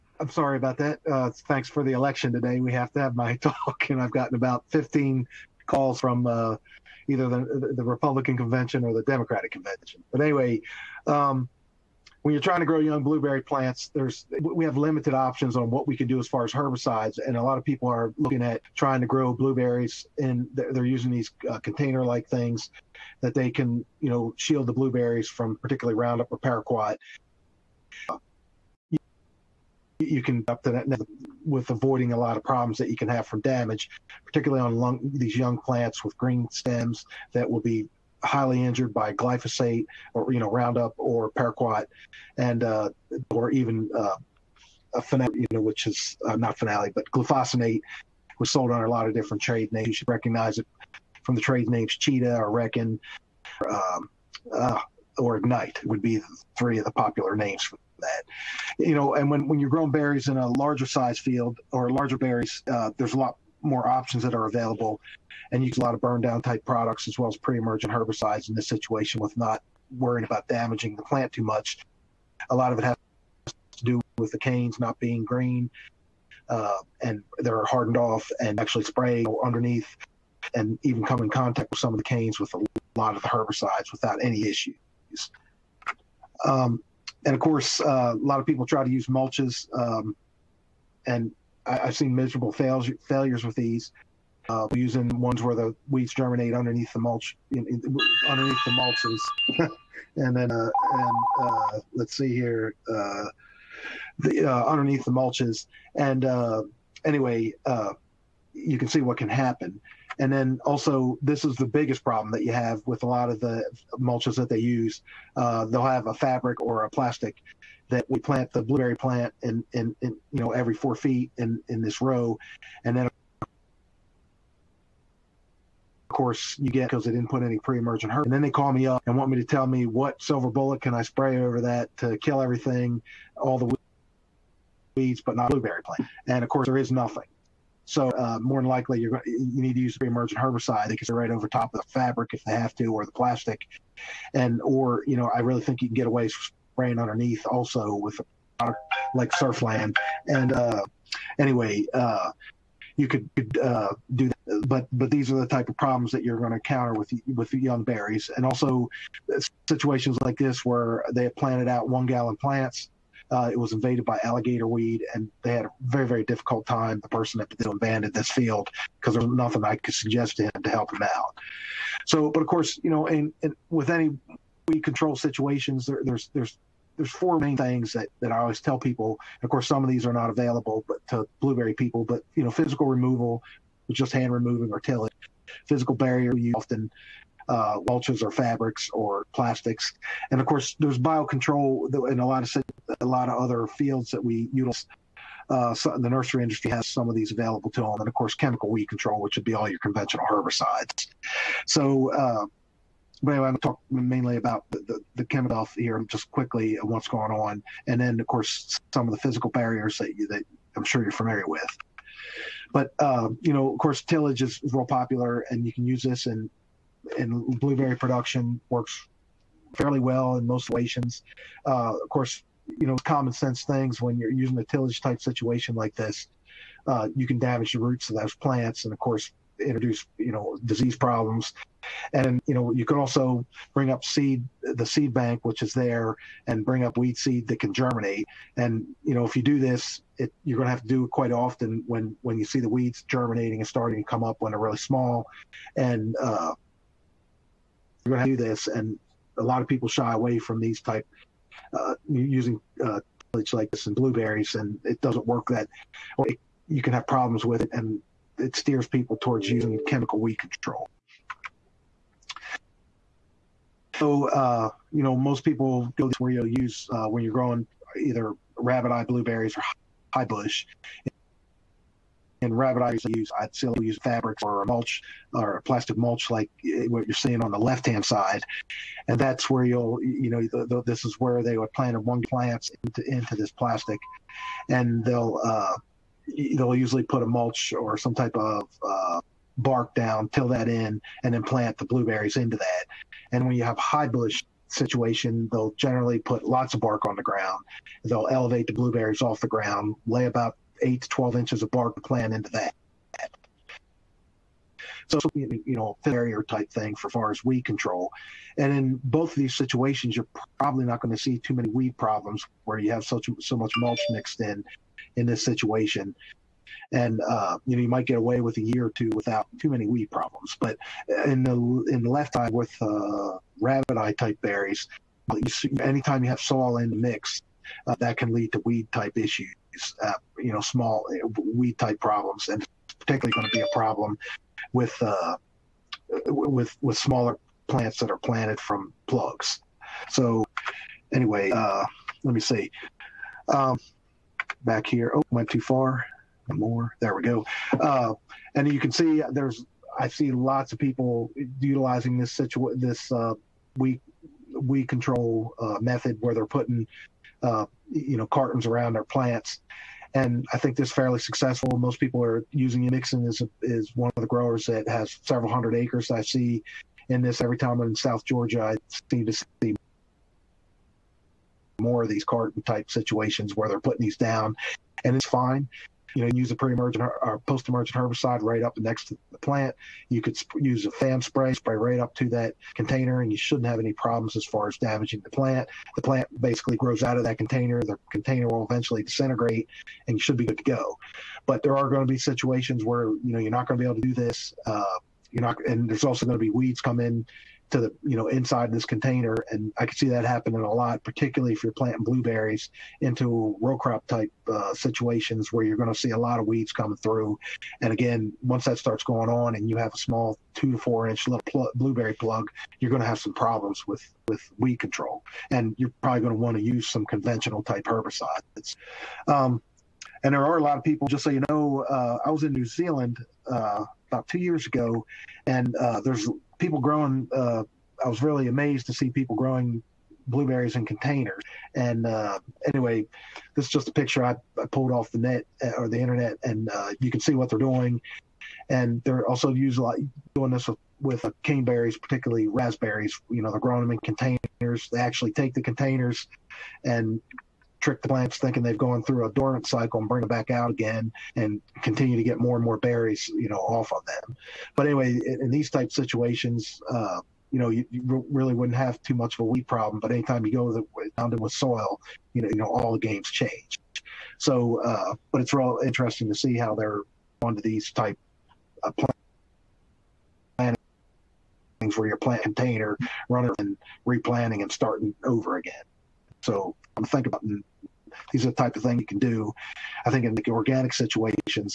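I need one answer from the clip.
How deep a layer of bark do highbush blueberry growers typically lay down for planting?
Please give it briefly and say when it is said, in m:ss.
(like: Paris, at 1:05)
8 to 12 inches, at 5:00.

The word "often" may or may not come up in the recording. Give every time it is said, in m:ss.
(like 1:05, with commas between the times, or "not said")
3:06, 4:01.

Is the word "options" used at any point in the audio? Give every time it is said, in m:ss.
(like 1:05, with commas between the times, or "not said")
0:15, 1:03.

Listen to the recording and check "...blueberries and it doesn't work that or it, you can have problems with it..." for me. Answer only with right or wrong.
right.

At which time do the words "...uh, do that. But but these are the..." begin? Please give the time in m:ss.
2:33.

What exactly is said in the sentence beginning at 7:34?
But anyway, in, in these type situations, uh, you know, you, you, really wouldn't have too much of a weed problem.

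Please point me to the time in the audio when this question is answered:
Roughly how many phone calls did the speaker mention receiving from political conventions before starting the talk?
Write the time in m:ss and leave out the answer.
0:04.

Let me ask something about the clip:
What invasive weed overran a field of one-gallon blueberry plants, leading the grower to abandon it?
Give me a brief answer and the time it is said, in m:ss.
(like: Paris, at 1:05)
alligator weed, at 2:44.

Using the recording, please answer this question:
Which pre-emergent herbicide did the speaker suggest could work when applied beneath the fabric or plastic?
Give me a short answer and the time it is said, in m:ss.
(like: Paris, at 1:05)
Surflan, at 2:29.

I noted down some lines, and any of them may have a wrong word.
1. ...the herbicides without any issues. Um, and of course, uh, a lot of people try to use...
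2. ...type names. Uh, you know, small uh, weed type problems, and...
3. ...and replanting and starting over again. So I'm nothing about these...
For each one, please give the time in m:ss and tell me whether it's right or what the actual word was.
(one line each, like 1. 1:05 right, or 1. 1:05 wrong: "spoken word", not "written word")
1. 1:23 right
2. 5:28 wrong: "issues", not "names"
3. 7:53 wrong: "thinking", not "nothing".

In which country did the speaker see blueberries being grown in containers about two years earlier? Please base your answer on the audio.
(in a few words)
New Zealand.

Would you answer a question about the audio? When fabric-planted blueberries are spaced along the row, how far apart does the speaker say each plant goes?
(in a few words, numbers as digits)
4 feet.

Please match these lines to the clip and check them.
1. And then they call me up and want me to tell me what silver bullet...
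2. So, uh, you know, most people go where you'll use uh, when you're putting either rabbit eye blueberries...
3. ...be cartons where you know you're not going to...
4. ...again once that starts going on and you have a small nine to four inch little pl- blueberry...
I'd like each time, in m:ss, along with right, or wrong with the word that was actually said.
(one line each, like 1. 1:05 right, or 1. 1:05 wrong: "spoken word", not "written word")
1. 2:08 right
2. 4:23 wrong: "growing", not "putting"
3. 6:32 wrong: "situations", not "cartons"
4. 6:47 wrong: "two", not "nine".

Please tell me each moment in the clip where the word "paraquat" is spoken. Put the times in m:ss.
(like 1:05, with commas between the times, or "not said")
0:26, 0:41.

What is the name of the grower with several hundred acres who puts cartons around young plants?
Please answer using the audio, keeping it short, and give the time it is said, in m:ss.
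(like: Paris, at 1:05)
Mixon, at 6:03.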